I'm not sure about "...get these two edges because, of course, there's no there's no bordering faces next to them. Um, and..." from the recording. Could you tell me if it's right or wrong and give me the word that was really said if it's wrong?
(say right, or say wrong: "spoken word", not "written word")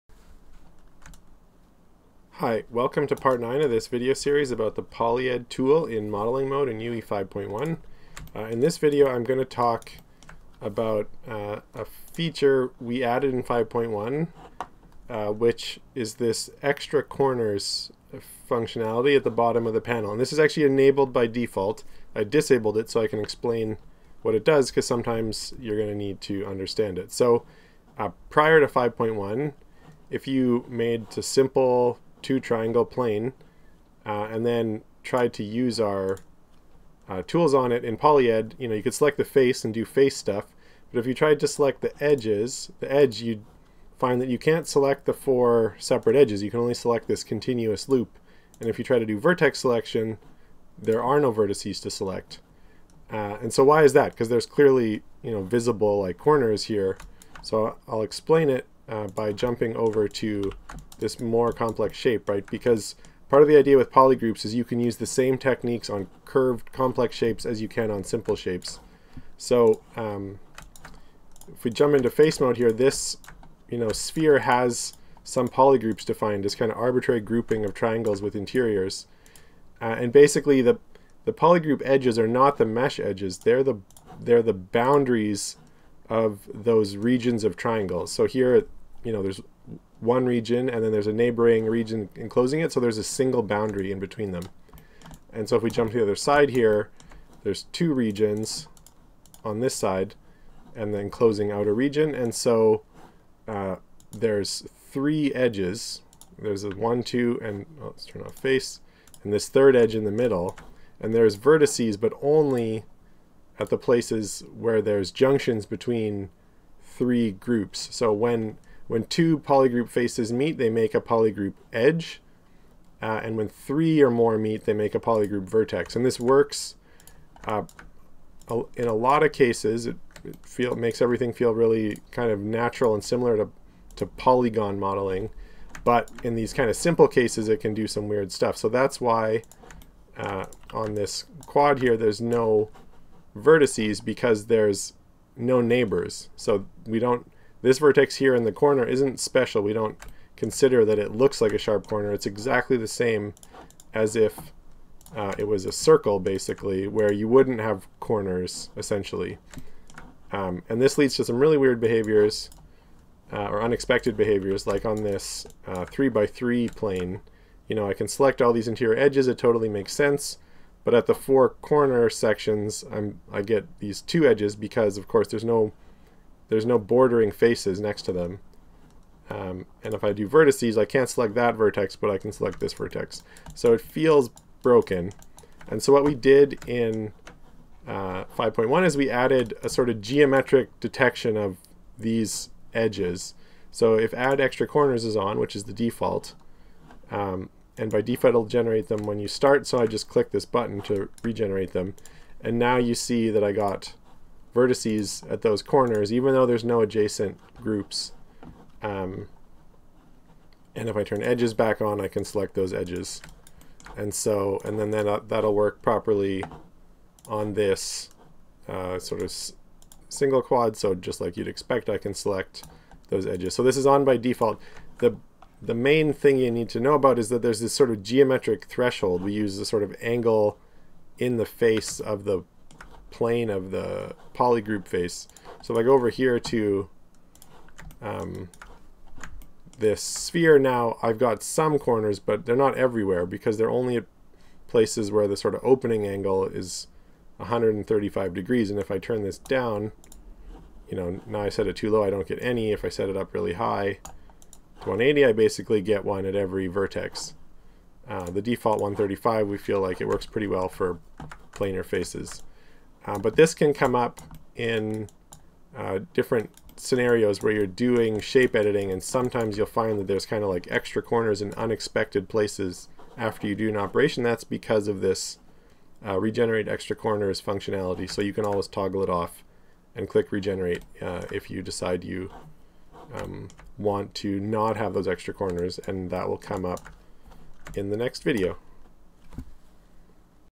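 right.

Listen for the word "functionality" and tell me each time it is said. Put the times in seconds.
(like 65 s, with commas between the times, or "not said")
18 s, 277 s.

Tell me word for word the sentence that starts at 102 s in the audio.
And so uh, there's three edges.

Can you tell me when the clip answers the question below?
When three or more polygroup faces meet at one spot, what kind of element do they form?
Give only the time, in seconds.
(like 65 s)
124 s.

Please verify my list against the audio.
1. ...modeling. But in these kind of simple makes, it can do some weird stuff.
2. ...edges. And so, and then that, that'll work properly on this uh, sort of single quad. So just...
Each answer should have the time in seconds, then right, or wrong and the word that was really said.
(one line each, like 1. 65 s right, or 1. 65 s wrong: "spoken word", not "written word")
1. 134 s wrong: "cases", not "makes"
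2. 212 s right.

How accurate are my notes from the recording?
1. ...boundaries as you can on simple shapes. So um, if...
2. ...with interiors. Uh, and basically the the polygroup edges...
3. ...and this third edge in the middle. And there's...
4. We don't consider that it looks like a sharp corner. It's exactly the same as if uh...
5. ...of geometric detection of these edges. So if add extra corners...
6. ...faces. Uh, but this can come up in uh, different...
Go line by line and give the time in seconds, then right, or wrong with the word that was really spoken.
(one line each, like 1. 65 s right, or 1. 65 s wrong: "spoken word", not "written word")
1. 67 s wrong: "shapes", not "boundaries"
2. 78 s right
3. 109 s right
4. 149 s right
5. 189 s right
6. 261 s right.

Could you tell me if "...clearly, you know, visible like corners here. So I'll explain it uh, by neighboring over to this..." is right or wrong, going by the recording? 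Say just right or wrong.
wrong.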